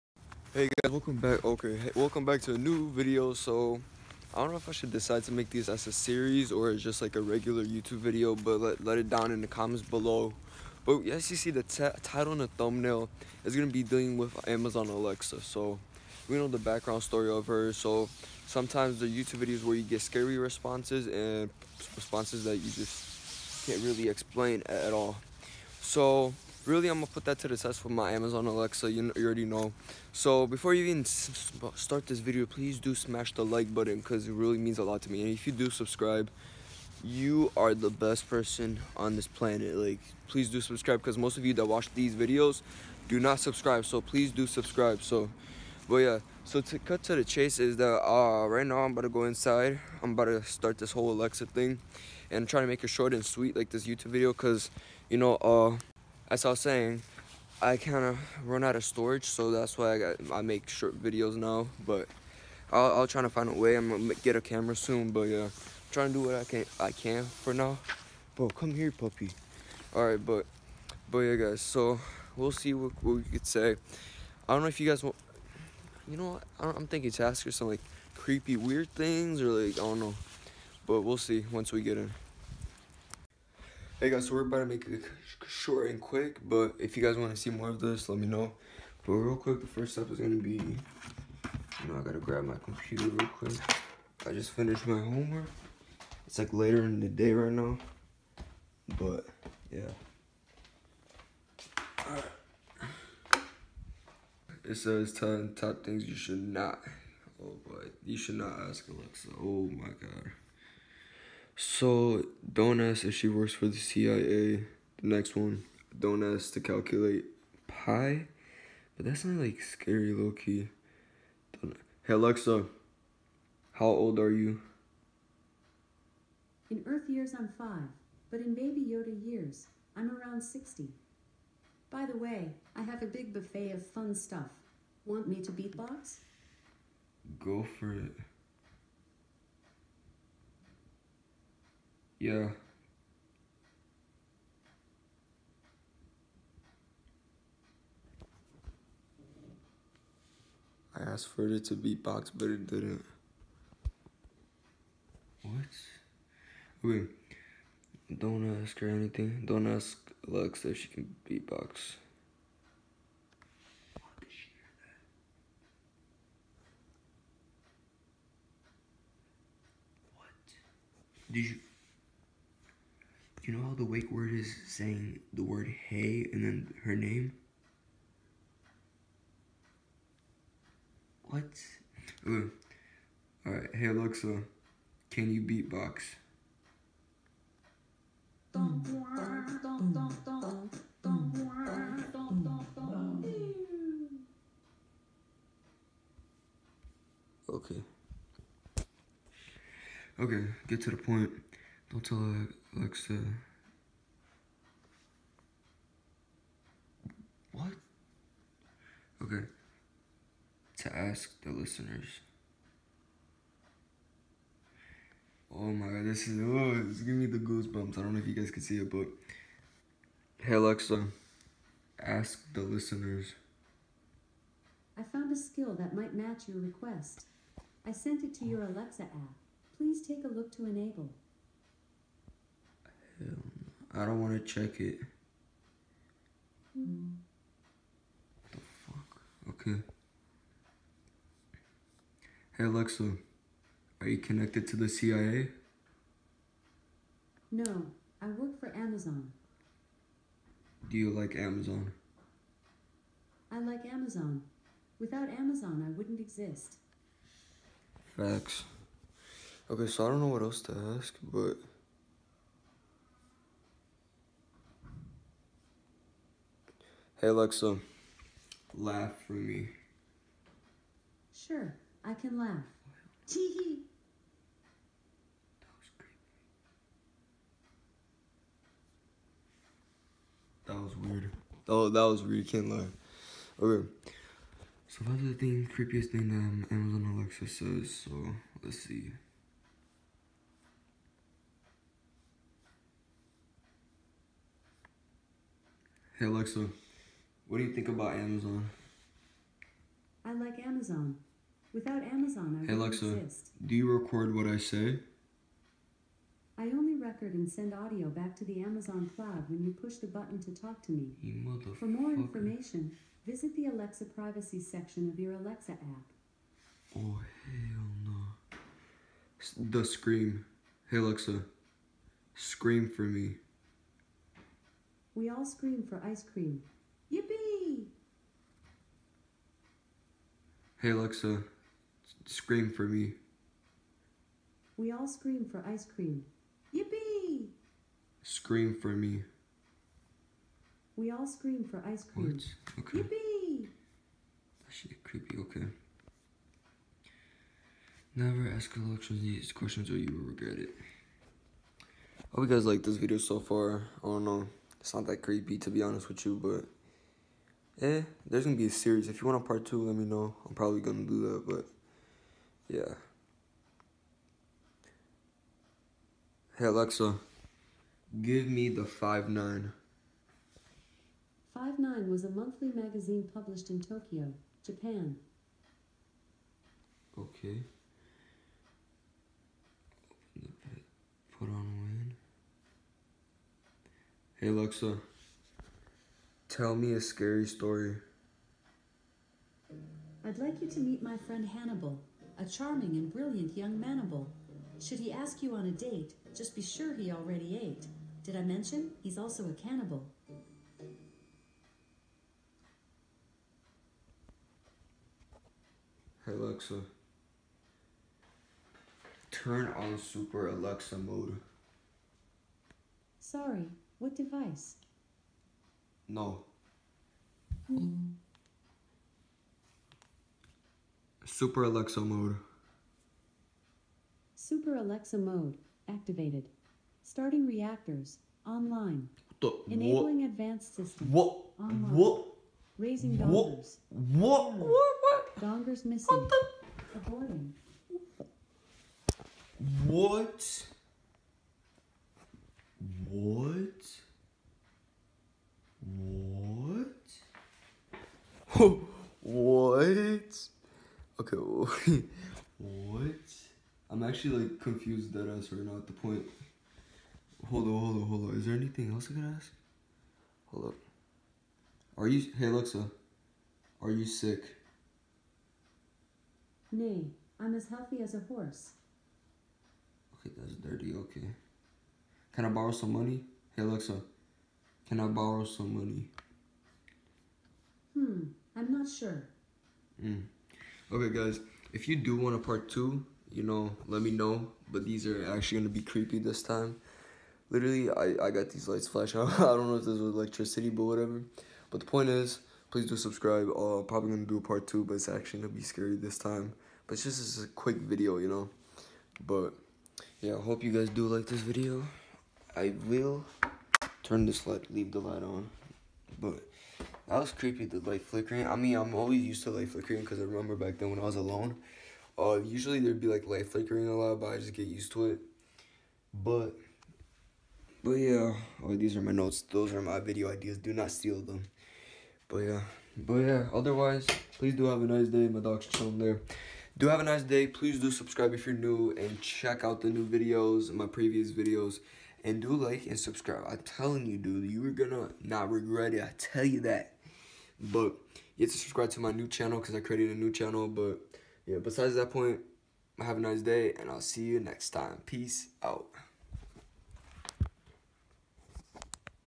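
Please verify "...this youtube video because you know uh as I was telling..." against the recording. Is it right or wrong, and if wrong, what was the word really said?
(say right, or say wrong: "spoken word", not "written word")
wrong: "saying", not "telling".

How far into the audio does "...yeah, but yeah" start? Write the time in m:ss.
8:42.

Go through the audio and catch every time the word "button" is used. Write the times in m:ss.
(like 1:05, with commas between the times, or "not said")
0:33, 5:10.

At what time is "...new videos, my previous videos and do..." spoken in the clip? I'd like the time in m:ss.
8:49.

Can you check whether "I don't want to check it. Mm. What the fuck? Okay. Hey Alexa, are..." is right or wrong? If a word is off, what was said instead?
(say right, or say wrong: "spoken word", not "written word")
right.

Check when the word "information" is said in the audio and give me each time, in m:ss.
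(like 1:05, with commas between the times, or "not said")
5:12.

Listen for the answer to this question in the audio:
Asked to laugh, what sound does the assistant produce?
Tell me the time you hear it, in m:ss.
4:33.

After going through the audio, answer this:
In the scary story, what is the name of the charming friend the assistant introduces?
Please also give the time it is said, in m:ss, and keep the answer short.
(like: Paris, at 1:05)
Hannibal, at 6:31.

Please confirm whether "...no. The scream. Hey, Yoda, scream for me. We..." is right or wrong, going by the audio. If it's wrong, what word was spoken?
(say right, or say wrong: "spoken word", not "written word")
wrong: "Alexa", not "Yoda".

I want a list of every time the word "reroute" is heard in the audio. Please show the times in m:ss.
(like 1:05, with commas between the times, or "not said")
not said.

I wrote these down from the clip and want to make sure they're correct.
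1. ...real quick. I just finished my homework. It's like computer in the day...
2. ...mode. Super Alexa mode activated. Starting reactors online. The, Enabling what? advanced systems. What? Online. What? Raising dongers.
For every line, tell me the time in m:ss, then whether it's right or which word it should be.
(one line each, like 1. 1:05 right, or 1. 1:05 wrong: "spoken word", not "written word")
1. 1:33 wrong: "later", not "computer"
2. 7:02 right.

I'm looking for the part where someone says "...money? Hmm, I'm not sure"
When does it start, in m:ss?
7:55.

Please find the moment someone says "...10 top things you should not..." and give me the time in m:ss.
1:45.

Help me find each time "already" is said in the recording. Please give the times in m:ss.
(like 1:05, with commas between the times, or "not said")
0:29, 6:37.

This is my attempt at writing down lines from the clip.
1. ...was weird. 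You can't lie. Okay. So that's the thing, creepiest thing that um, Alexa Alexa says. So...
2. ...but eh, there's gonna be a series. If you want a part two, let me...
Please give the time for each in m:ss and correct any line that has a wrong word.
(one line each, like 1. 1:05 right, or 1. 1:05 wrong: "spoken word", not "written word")
1. 4:42 wrong: "Amazon", not "Alexa"
2. 5:56 right.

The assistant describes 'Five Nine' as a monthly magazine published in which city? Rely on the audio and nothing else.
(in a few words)
Tokyo.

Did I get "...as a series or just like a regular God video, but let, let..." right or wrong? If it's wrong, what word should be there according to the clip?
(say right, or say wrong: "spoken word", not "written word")
wrong: "YouTube", not "God".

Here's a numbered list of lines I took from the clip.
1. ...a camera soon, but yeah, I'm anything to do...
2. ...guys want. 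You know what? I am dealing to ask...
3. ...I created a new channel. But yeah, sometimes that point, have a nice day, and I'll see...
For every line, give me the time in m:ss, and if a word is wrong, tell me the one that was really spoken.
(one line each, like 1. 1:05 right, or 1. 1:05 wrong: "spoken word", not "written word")
1. 1:04 wrong: "trying", not "anything"
2. 1:14 wrong: "thinking", not "dealing"
3. 8:59 wrong: "besides", not "sometimes".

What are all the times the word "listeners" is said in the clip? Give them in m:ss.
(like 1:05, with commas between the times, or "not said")
3:31, 3:42.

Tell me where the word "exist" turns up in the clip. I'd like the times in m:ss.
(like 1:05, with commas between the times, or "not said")
4:16, 5:03.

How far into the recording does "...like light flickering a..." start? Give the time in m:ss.
8:33.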